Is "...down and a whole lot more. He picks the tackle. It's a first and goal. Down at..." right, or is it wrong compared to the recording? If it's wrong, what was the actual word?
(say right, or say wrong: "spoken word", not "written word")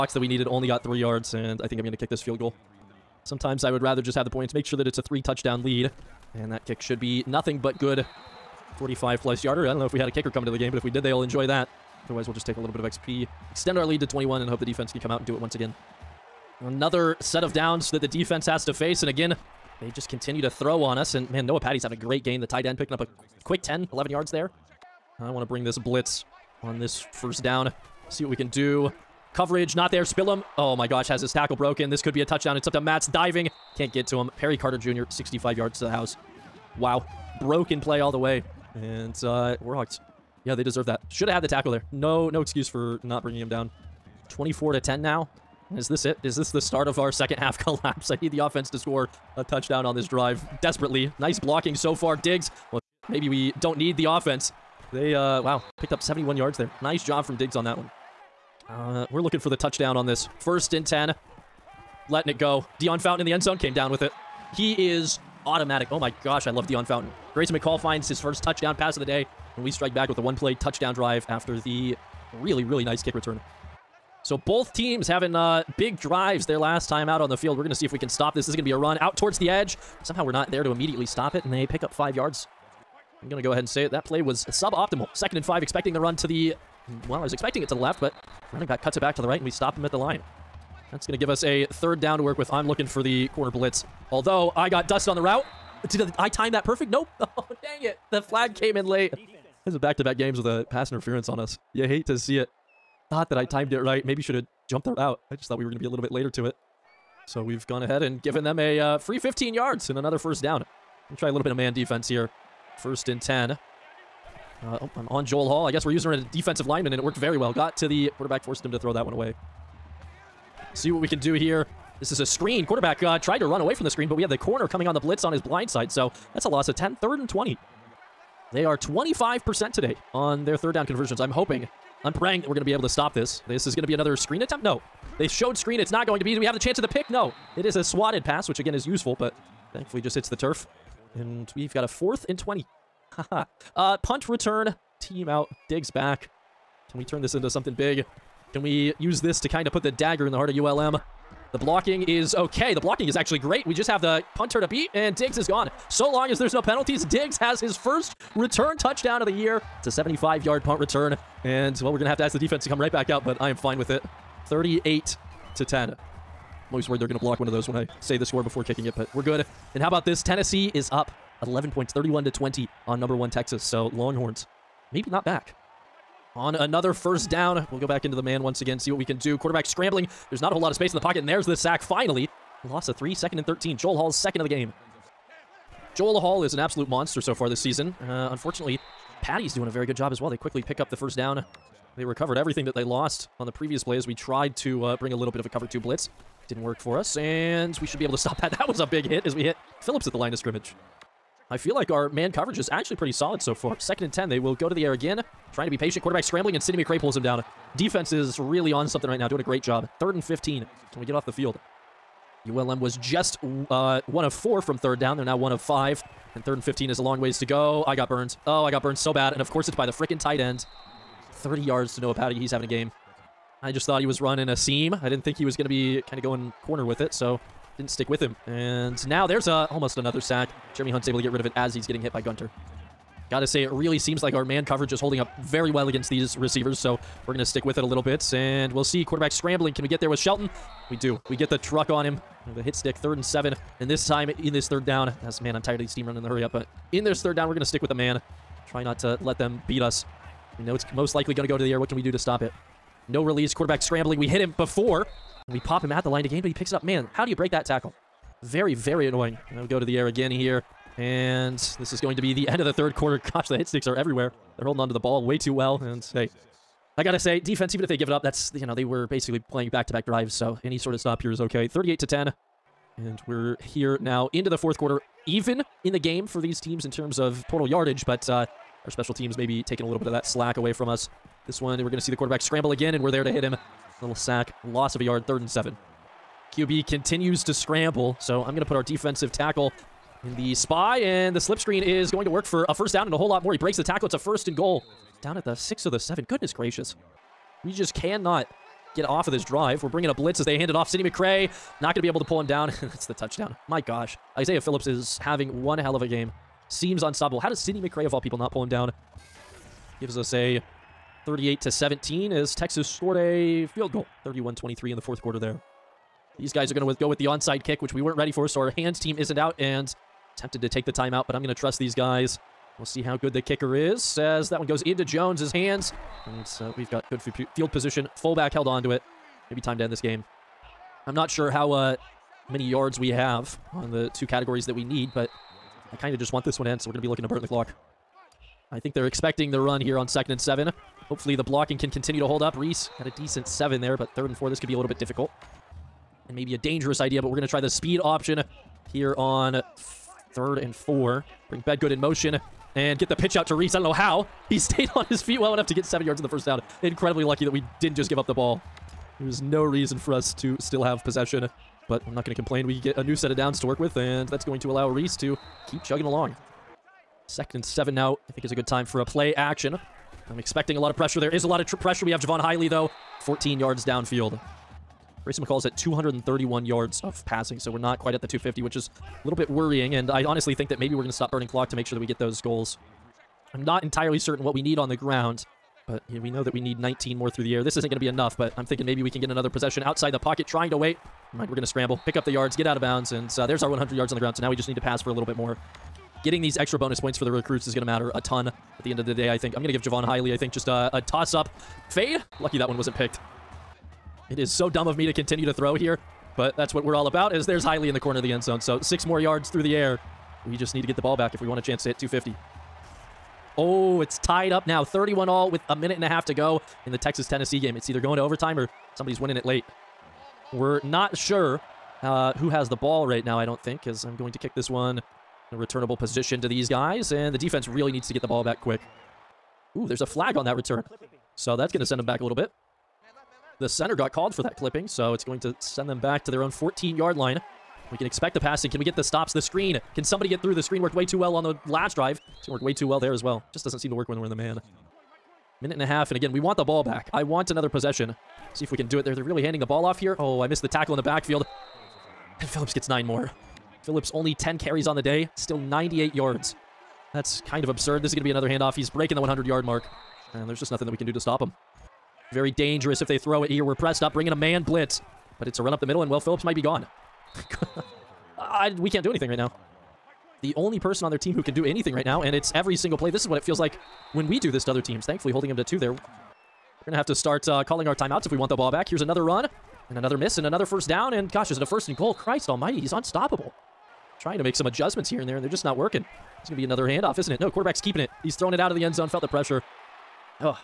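wrong: "breaks", not "picks".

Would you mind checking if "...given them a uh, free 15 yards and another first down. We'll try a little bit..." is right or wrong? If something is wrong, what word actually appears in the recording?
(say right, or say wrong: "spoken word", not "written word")
right.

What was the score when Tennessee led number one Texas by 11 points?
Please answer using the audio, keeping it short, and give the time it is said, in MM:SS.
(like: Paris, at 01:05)
31 to 20, at 02:51.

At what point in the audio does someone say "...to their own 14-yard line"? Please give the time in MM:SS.
07:16.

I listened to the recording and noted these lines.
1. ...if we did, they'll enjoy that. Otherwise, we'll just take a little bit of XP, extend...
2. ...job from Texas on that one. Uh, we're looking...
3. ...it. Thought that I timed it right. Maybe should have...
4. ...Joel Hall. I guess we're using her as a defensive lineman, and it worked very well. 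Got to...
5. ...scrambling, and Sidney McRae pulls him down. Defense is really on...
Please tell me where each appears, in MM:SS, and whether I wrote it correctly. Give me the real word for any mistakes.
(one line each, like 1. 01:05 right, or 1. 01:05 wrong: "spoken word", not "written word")
1. 00:10 right
2. 00:57 wrong: "Diggs", not "Texas"
3. 01:42 right
4. 01:55 right
5. 03:26 right.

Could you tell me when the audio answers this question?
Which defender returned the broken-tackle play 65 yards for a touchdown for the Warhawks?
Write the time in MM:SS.
00:34.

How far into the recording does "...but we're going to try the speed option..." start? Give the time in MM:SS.
05:47.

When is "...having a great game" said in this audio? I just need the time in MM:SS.
00:21.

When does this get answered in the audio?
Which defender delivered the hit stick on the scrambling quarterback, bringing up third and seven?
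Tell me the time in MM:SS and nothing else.
04:00.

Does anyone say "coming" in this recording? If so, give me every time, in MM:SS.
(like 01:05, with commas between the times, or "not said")
00:10, 02:04.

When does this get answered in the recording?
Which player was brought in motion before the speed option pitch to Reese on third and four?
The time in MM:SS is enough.
05:51.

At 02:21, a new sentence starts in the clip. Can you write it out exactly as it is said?
And we've got a fourth and 20.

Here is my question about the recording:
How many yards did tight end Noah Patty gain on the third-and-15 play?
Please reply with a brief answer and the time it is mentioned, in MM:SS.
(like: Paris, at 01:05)
30, at 03:41.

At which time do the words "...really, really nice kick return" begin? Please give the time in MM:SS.
01:12.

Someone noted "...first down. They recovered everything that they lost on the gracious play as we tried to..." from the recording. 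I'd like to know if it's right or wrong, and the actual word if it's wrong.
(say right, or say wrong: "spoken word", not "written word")
wrong: "previous", not "gracious".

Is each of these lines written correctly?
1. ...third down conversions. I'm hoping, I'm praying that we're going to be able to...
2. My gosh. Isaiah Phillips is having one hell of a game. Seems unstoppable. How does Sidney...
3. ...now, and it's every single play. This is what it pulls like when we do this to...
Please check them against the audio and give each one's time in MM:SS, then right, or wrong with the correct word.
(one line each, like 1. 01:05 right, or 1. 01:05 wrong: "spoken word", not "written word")
1. 02:10 right
2. 05:03 right
3. 07:52 wrong: "feels", not "pulls".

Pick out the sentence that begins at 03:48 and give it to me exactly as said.
And now there's a, almost another sack.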